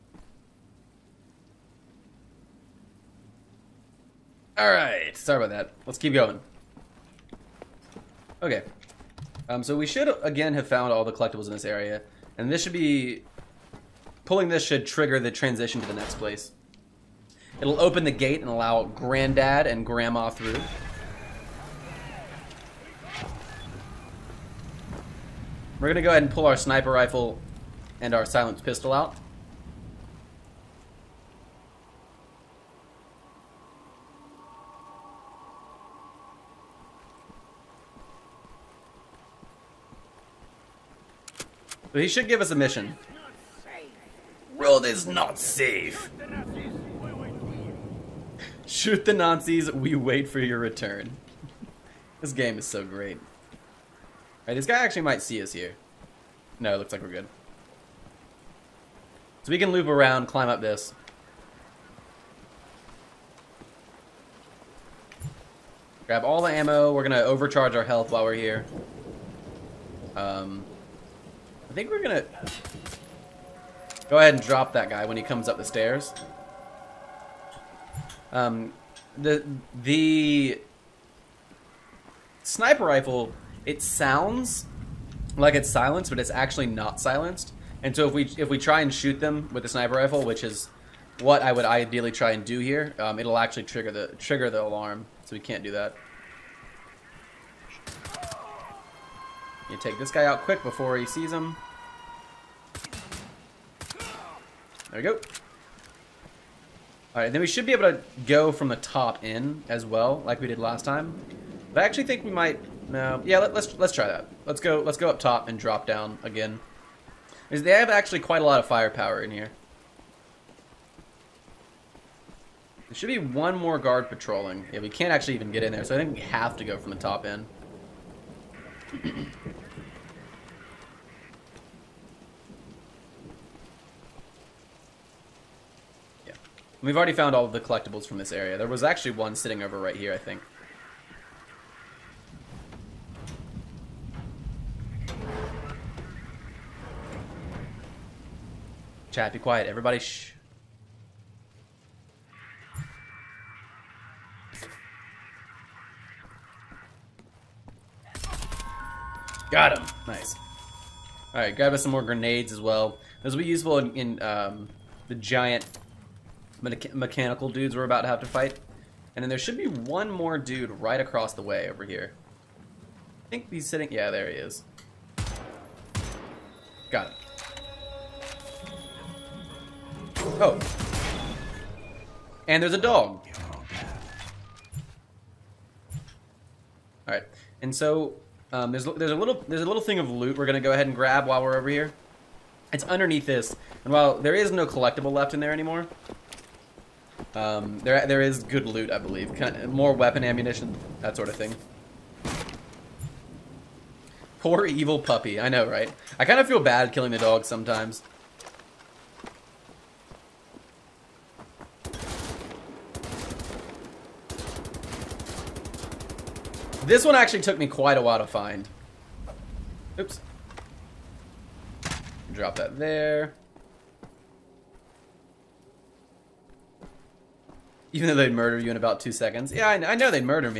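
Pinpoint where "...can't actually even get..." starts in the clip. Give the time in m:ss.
2:04.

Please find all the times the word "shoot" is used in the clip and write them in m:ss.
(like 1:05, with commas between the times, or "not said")
0:48, 1:28.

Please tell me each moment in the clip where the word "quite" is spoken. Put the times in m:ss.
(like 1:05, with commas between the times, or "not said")
1:58, 3:37.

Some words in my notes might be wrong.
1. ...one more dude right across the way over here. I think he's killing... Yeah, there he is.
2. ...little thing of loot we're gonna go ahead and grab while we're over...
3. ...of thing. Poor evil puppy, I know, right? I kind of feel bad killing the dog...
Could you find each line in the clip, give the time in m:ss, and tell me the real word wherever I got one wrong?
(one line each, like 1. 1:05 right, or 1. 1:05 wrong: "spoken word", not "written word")
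1. 2:49 wrong: "sitting", not "killing"
2. 3:09 right
3. 3:21 right.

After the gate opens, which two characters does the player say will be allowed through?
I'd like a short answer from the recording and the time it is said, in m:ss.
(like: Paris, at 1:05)
Granddad and Grandma, at 0:18.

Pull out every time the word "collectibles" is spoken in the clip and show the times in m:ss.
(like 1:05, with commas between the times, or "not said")
0:11, 2:17, 3:14.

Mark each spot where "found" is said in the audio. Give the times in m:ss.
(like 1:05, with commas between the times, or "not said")
0:10, 2:17.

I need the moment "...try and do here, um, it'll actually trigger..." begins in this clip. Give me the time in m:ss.
1:32.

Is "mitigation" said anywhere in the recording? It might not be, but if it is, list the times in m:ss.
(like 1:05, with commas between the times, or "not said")
not said.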